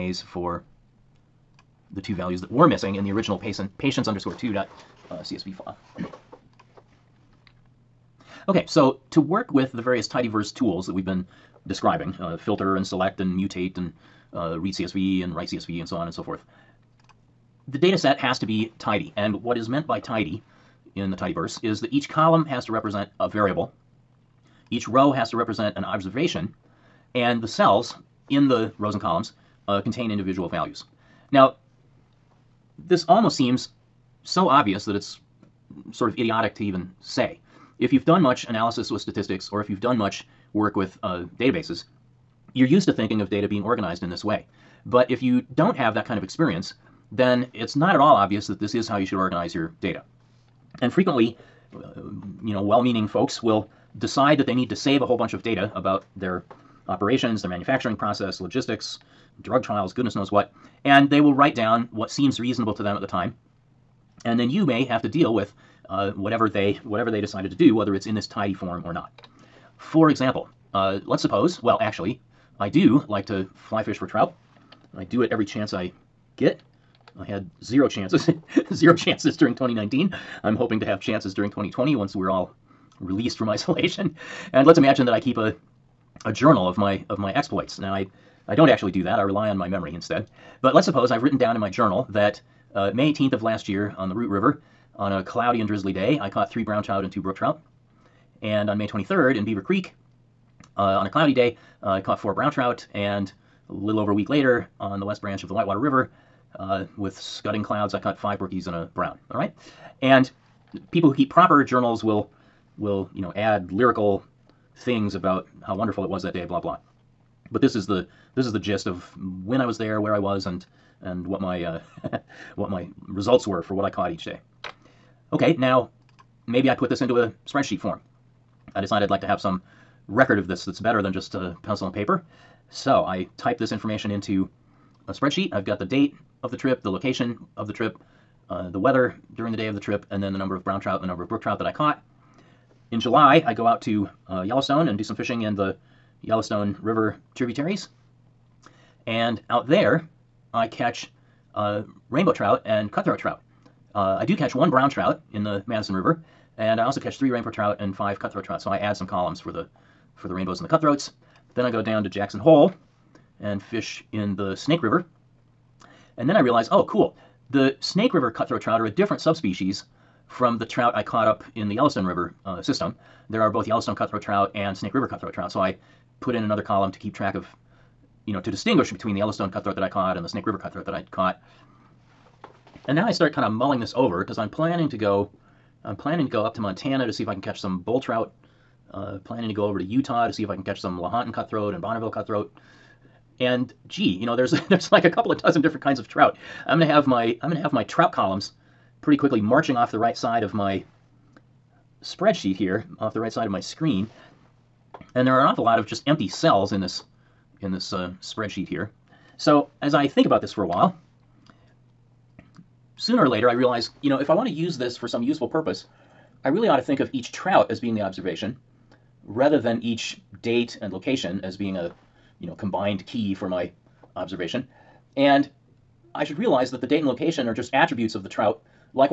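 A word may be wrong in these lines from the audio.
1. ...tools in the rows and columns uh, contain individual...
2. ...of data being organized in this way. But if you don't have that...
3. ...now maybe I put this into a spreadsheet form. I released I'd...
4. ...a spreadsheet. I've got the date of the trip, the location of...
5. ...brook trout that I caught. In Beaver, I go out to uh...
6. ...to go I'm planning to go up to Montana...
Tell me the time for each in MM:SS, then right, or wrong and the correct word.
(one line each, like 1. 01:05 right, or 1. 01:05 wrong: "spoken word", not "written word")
1. 00:27 wrong: "cells", not "tools"
2. 00:43 right
3. 02:05 wrong: "decided", not "released"
4. 02:15 right
5. 02:21 wrong: "July", not "Beaver"
6. 03:04 right.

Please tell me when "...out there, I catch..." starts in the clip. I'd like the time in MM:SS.
02:29.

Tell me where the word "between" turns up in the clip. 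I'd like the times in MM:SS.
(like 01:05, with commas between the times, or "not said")
02:58.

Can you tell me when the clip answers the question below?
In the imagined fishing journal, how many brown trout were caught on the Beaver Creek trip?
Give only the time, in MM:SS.
01:42.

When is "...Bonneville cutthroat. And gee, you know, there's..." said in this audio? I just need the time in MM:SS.
03:11.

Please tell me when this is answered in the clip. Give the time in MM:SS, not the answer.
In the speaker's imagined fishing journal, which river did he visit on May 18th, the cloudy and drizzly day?
01:34.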